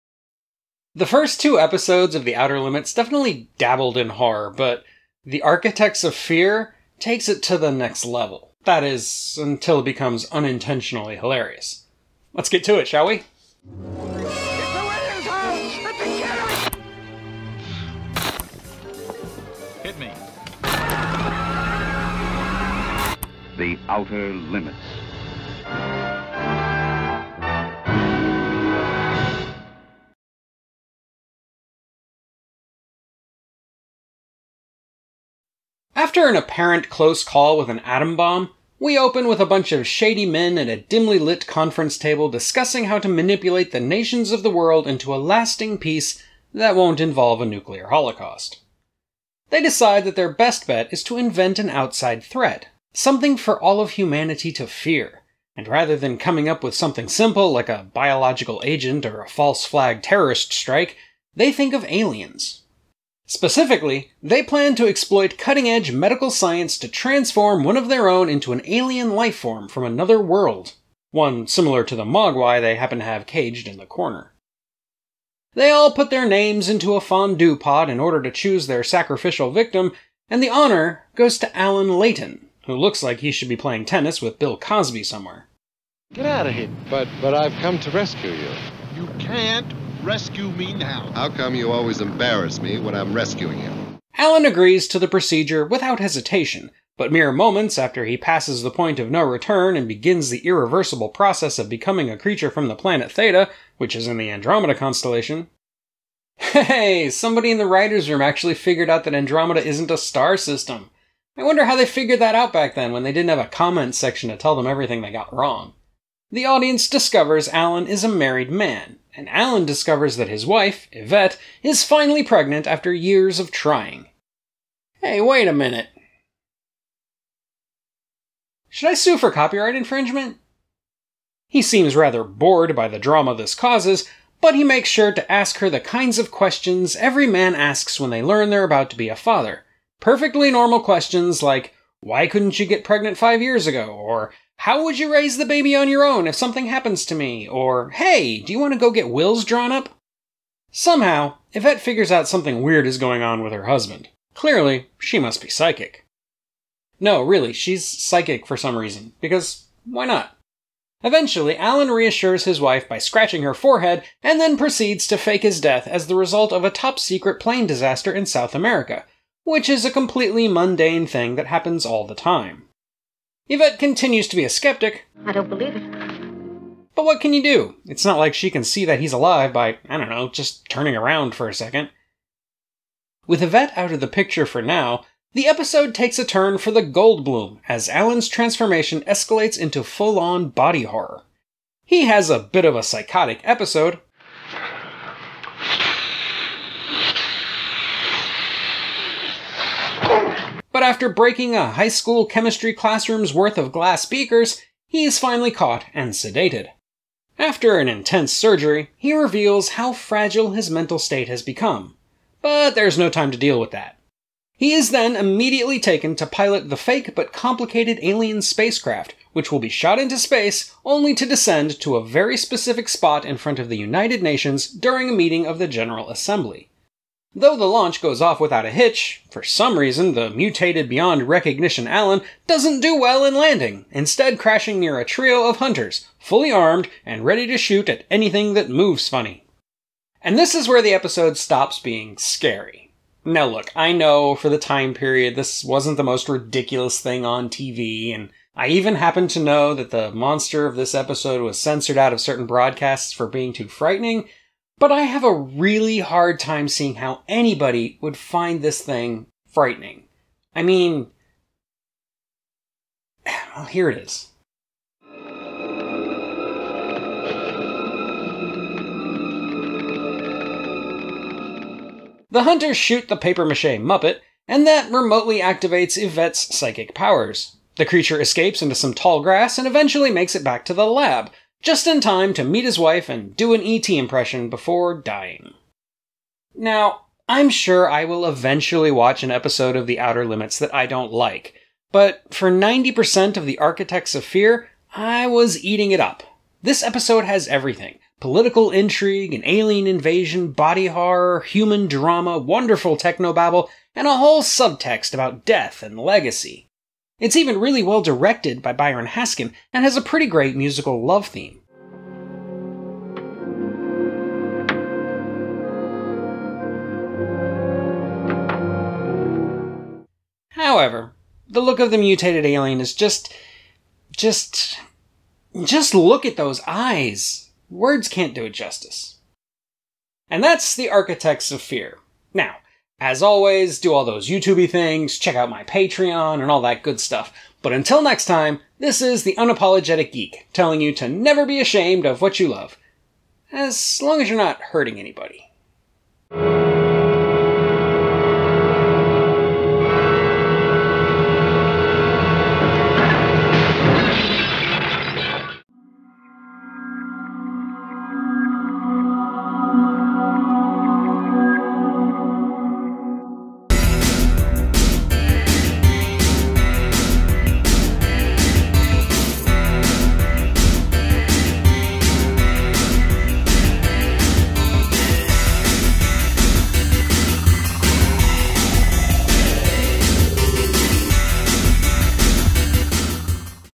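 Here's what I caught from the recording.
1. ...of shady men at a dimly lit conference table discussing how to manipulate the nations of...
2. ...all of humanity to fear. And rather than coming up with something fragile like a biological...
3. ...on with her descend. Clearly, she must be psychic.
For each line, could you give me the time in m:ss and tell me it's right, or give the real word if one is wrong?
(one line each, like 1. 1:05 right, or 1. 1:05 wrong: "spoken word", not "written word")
1. 0:39 right
2. 0:53 wrong: "simple", not "fragile"
3. 2:33 wrong: "husband", not "descend".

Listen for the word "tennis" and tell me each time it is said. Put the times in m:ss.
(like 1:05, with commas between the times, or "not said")
1:23.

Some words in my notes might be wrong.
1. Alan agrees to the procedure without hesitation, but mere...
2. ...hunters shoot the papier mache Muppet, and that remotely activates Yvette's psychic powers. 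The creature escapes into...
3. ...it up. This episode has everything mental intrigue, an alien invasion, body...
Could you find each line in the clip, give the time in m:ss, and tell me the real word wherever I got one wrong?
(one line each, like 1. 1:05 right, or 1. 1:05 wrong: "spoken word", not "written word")
1. 1:34 right
2. 4:32 right
3. 4:55 wrong: "political", not "mental".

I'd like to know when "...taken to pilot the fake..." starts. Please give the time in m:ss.
3:35.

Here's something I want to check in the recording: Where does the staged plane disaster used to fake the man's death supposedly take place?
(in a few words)
South America.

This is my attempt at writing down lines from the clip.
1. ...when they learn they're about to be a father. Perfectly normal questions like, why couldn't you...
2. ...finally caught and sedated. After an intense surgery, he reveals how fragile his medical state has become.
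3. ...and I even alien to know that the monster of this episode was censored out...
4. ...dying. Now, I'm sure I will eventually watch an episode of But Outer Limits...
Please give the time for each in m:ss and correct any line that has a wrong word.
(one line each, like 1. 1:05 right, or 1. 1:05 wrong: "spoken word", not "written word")
1. 2:17 right
2. 3:25 wrong: "mental", not "medical"
3. 4:08 wrong: "happen", not "alien"
4. 4:44 wrong: "The", not "But".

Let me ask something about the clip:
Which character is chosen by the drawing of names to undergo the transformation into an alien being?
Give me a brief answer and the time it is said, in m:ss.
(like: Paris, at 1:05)
Alan Leighton, at 1:21.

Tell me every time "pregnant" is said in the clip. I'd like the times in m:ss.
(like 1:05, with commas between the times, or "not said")
2:02, 2:22.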